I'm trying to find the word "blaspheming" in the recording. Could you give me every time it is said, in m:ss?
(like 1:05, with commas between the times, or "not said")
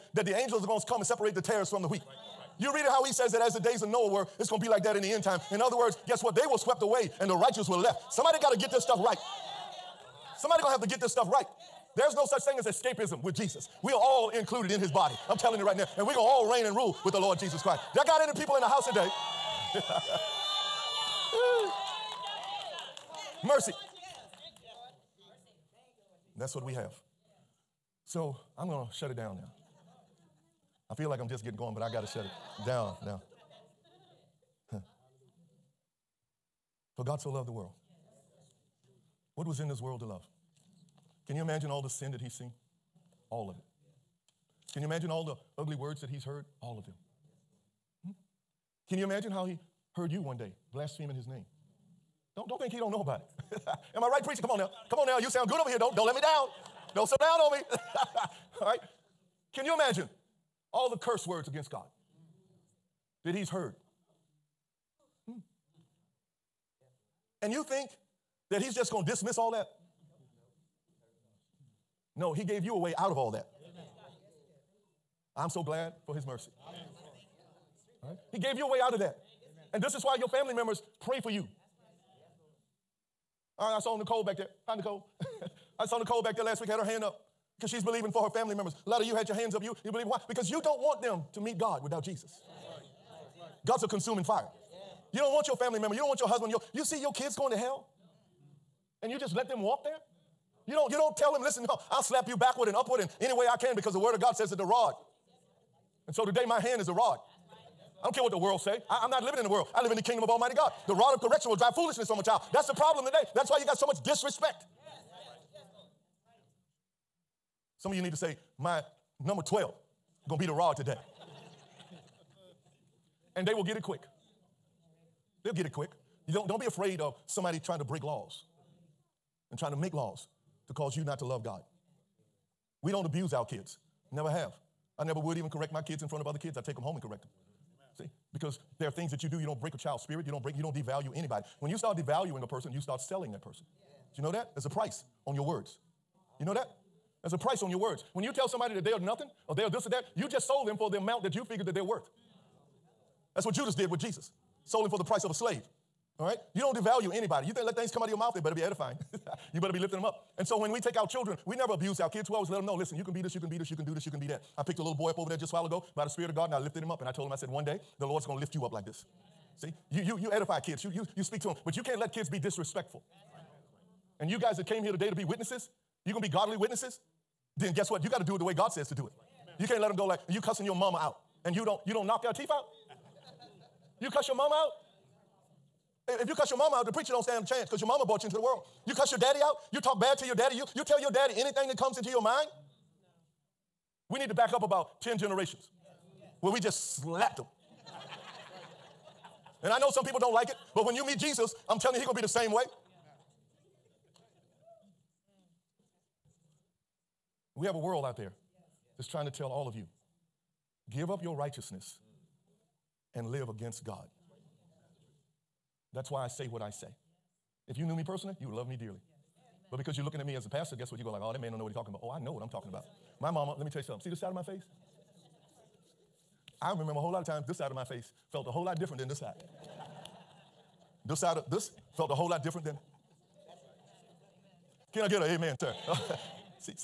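0:50.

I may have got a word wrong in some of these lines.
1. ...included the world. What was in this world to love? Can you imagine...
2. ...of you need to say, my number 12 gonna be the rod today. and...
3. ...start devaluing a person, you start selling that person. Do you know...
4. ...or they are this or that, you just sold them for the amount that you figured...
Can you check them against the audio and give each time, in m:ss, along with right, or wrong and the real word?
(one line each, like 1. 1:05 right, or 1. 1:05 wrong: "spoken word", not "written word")
1. 0:37 wrong: "loved", not "included"
2. 1:57 right
3. 2:21 right
4. 2:29 right.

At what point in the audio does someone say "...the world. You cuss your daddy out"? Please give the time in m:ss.
3:08.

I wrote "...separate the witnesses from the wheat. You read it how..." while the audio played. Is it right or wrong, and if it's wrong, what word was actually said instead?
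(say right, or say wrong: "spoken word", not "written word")
wrong: "tares", not "witnesses".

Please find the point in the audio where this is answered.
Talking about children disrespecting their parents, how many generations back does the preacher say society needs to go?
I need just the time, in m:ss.
3:15.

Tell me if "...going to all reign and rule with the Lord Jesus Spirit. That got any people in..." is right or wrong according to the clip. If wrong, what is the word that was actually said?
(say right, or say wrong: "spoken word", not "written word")
wrong: "Christ", not "Spirit".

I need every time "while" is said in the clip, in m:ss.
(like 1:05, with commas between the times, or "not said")
2:45.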